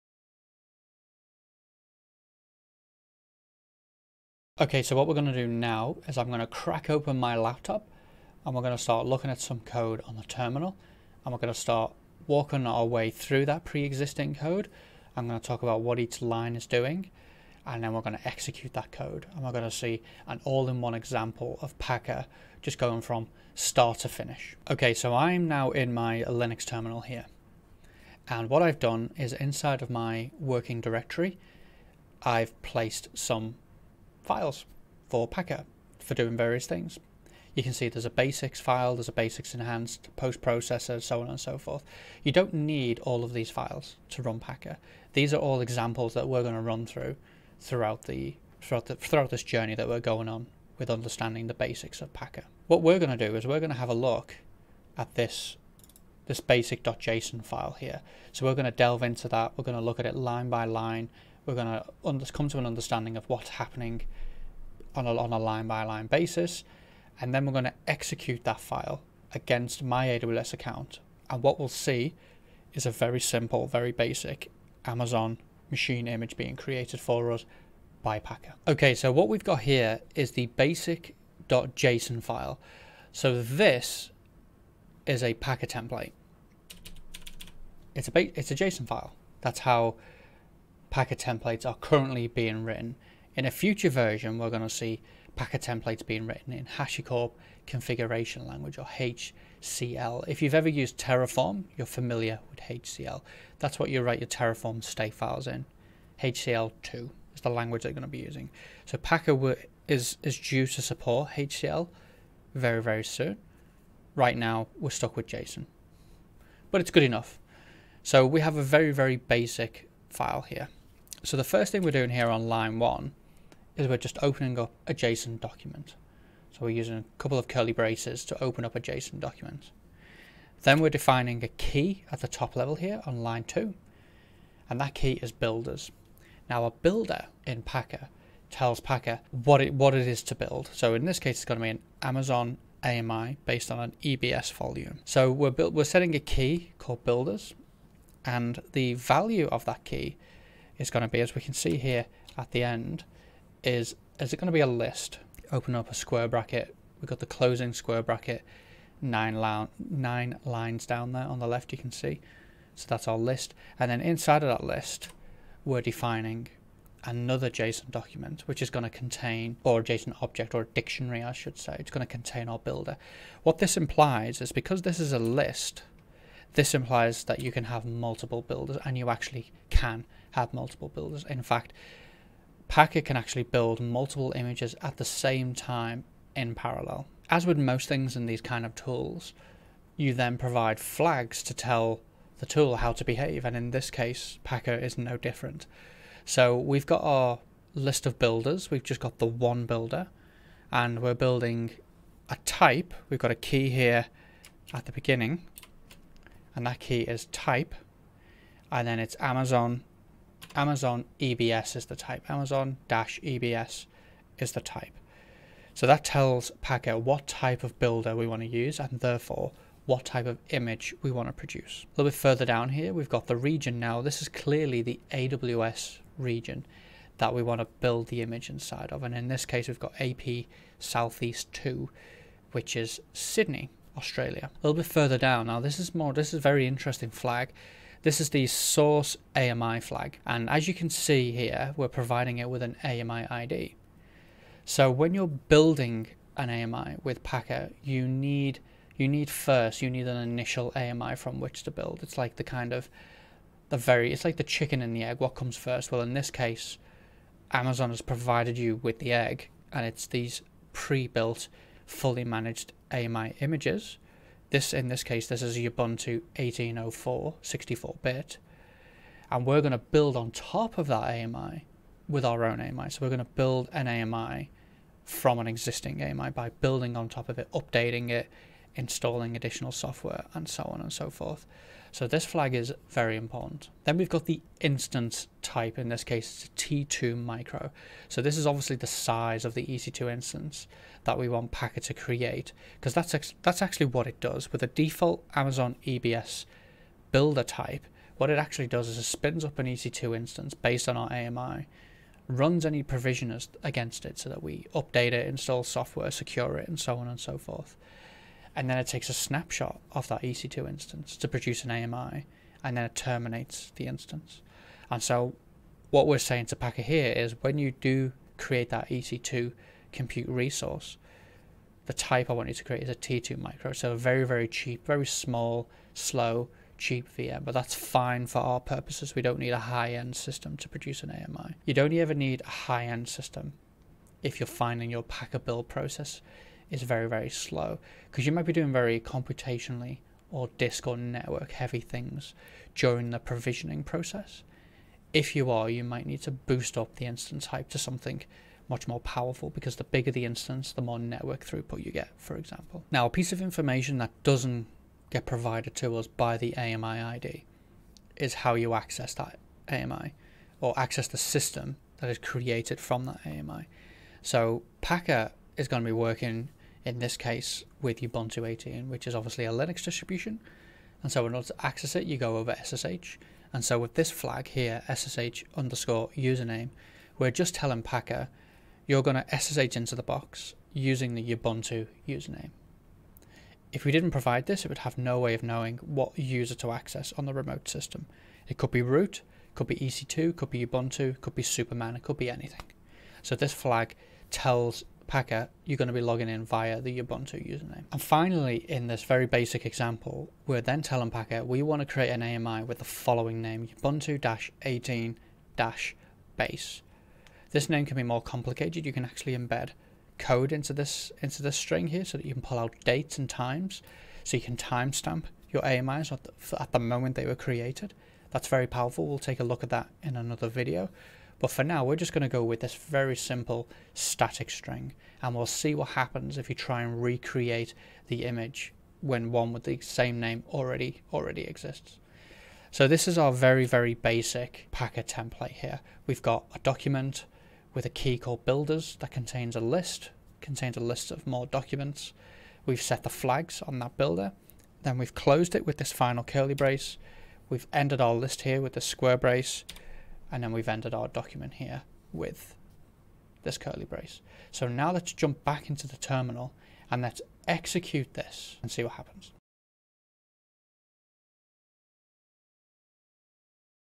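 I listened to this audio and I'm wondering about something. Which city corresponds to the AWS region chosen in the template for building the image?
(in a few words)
Sydney.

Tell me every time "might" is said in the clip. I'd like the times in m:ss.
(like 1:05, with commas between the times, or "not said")
5:38, 5:45.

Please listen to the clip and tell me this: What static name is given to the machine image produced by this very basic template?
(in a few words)
Ubuntu-18-base.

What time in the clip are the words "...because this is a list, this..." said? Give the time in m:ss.
2:54.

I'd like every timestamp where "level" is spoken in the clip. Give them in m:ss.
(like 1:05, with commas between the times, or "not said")
2:12.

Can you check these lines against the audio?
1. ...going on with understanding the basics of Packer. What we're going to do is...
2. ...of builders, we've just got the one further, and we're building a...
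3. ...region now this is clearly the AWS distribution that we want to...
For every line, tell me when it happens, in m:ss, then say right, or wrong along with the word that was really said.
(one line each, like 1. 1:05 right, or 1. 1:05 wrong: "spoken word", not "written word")
1. 0:49 right
2. 3:18 wrong: "builder", not "further"
3. 3:43 wrong: "region", not "distribution".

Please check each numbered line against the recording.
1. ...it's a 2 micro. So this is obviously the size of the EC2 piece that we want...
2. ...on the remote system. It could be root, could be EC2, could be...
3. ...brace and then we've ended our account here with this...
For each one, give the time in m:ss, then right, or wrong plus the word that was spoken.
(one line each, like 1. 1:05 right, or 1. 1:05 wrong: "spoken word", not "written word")
1. 4:46 wrong: "instance", not "piece"
2. 6:27 right
3. 7:29 wrong: "document", not "account".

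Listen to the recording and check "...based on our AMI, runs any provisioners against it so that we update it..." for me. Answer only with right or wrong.
right.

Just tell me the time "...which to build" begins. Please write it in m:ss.
4:11.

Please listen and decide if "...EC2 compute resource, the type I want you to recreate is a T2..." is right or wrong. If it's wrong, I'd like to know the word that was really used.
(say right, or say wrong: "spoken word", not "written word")
wrong: "create", not "recreate".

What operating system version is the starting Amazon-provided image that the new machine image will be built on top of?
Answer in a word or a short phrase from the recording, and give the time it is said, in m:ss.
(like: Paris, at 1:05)
Ubuntu 18.04, at 4:25.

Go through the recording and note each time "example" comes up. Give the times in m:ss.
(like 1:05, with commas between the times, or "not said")
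0:20, 0:45, 5:52, 6:39.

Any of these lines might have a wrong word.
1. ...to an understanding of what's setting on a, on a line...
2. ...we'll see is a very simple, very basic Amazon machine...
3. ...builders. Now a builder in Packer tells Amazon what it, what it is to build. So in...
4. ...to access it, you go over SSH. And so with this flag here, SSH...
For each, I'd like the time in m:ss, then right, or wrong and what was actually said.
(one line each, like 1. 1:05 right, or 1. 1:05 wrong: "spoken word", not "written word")
1. 1:02 wrong: "happening", not "setting"
2. 1:11 right
3. 2:15 wrong: "Packer", not "Amazon"
4. 6:11 right.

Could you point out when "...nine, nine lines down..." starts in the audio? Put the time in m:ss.
2:39.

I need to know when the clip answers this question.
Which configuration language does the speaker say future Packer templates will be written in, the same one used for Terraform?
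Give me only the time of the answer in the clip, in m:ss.
1:46.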